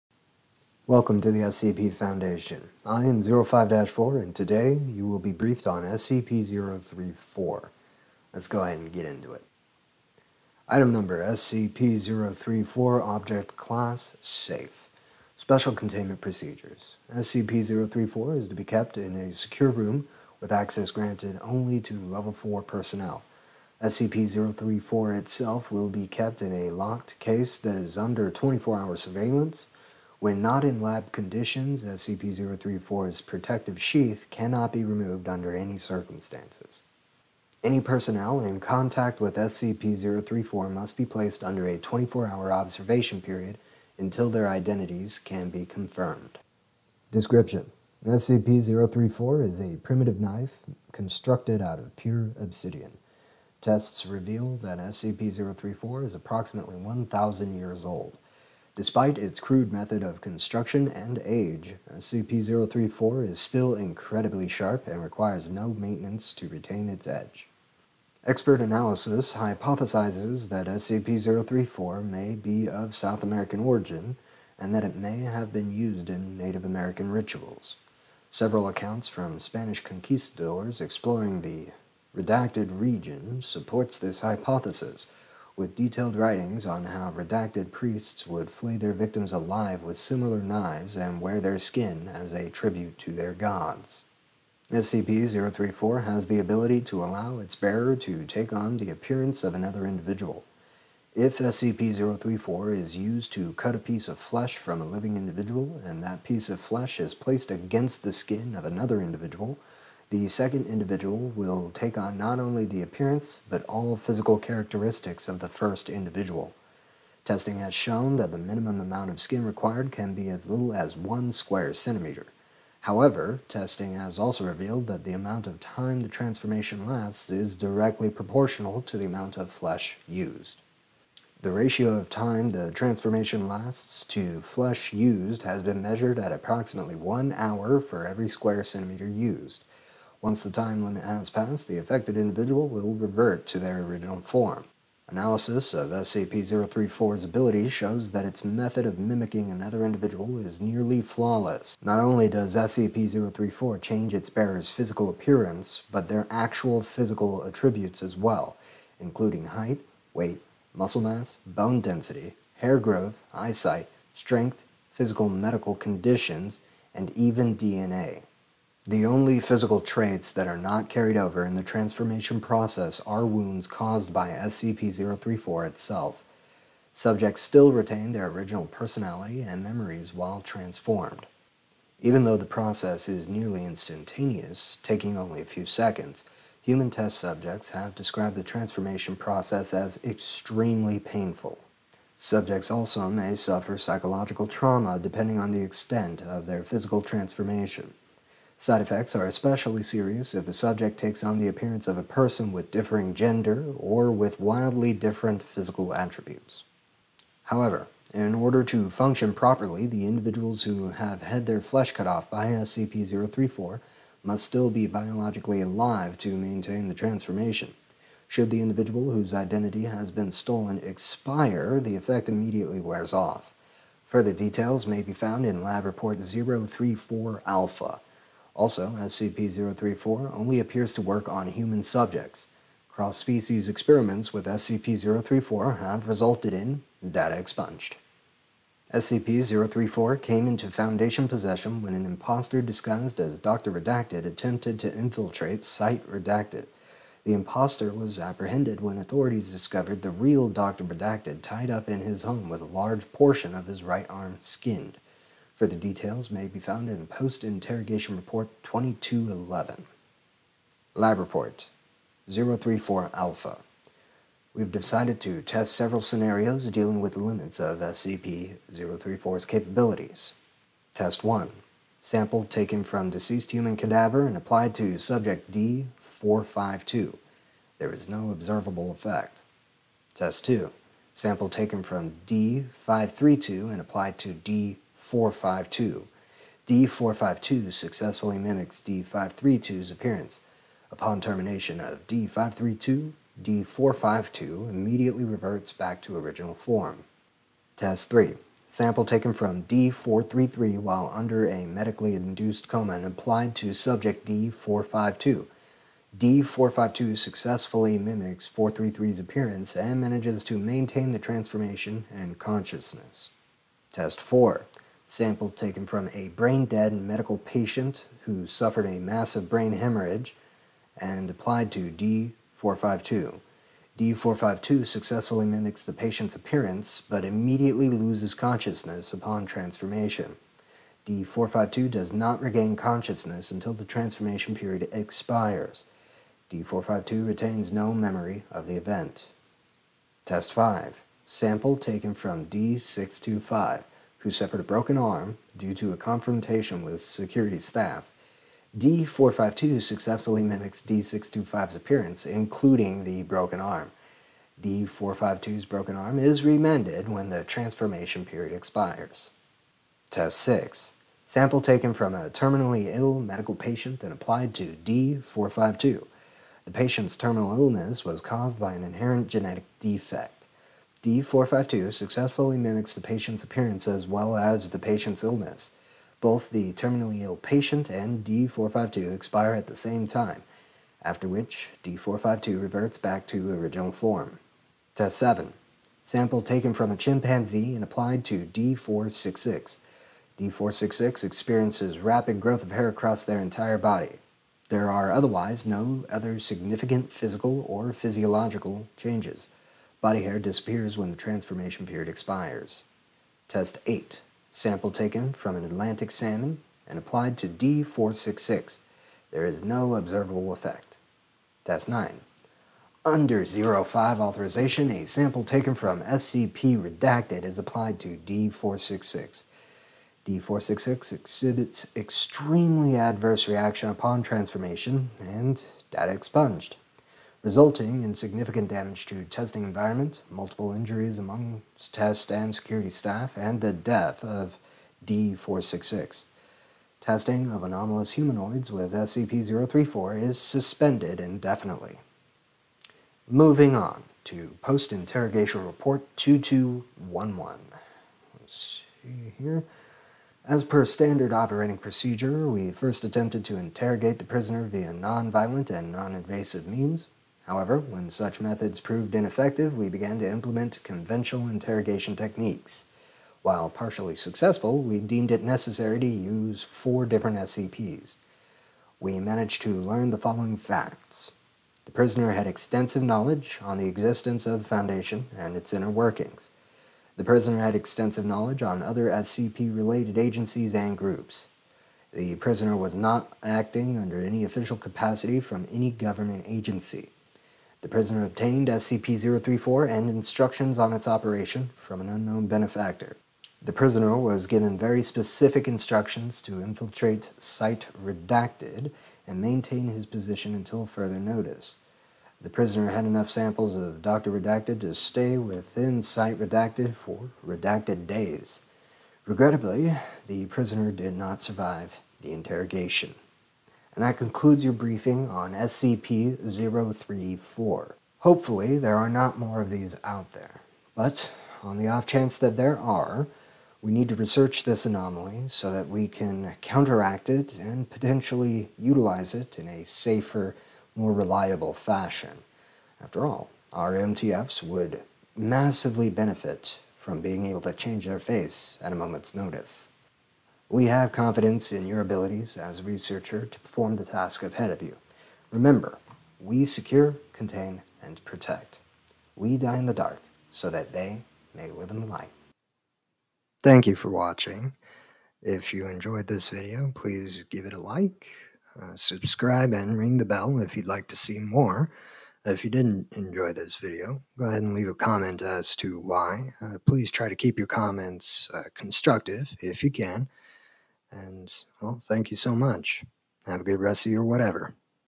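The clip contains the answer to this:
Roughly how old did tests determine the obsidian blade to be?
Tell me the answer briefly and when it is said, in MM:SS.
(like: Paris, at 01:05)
1,000 years, at 00:56.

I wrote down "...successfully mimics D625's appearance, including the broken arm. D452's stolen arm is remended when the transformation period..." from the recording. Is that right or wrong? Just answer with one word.
wrong.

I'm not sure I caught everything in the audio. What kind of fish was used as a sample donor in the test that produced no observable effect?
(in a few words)
Atlantic salmon.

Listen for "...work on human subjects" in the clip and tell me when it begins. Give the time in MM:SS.
03:51.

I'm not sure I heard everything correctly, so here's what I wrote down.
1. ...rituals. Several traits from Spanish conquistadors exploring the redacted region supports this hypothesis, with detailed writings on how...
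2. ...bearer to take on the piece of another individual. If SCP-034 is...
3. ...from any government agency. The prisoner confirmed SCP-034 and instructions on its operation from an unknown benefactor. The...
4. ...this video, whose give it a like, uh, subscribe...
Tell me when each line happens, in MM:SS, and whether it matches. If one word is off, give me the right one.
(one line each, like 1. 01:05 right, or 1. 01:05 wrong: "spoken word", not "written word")
1. 01:17 wrong: "accounts", not "traits"
2. 01:37 wrong: "appearance", not "piece"
3. 08:05 wrong: "obtained", not "confirmed"
4. 09:16 wrong: "please", not "whose".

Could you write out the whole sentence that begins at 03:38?
Should the individual whose identity has been stolen expire, the effect immediately wears off.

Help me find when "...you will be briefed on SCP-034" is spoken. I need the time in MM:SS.
00:04.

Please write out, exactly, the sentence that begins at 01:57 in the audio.
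Testing has shown that the minimum amount of skin required can be as little as one square centimeter.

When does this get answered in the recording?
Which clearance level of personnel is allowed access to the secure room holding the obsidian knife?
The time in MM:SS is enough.
00:22.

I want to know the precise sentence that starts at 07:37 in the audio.
However, when such methods proved ineffective, we began to implement conventional interrogation techniques.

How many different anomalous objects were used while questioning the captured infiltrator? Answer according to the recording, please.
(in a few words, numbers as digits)
4.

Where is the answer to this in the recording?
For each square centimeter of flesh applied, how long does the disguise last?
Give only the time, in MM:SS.
02:16.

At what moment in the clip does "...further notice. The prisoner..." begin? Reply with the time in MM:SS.
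08:20.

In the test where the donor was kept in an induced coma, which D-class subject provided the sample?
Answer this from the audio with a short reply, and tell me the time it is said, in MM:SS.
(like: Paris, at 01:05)
D433, at 04:59.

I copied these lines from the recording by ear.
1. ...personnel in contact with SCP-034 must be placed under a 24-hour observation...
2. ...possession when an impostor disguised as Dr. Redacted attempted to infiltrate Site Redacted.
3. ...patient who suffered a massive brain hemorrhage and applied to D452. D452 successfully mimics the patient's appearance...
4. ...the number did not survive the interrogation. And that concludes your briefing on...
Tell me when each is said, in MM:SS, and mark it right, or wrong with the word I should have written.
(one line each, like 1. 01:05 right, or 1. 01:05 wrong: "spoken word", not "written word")
1. 00:37 right
2. 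04:01 right
3. 05:17 right
4. 08:30 wrong: "prisoner", not "number".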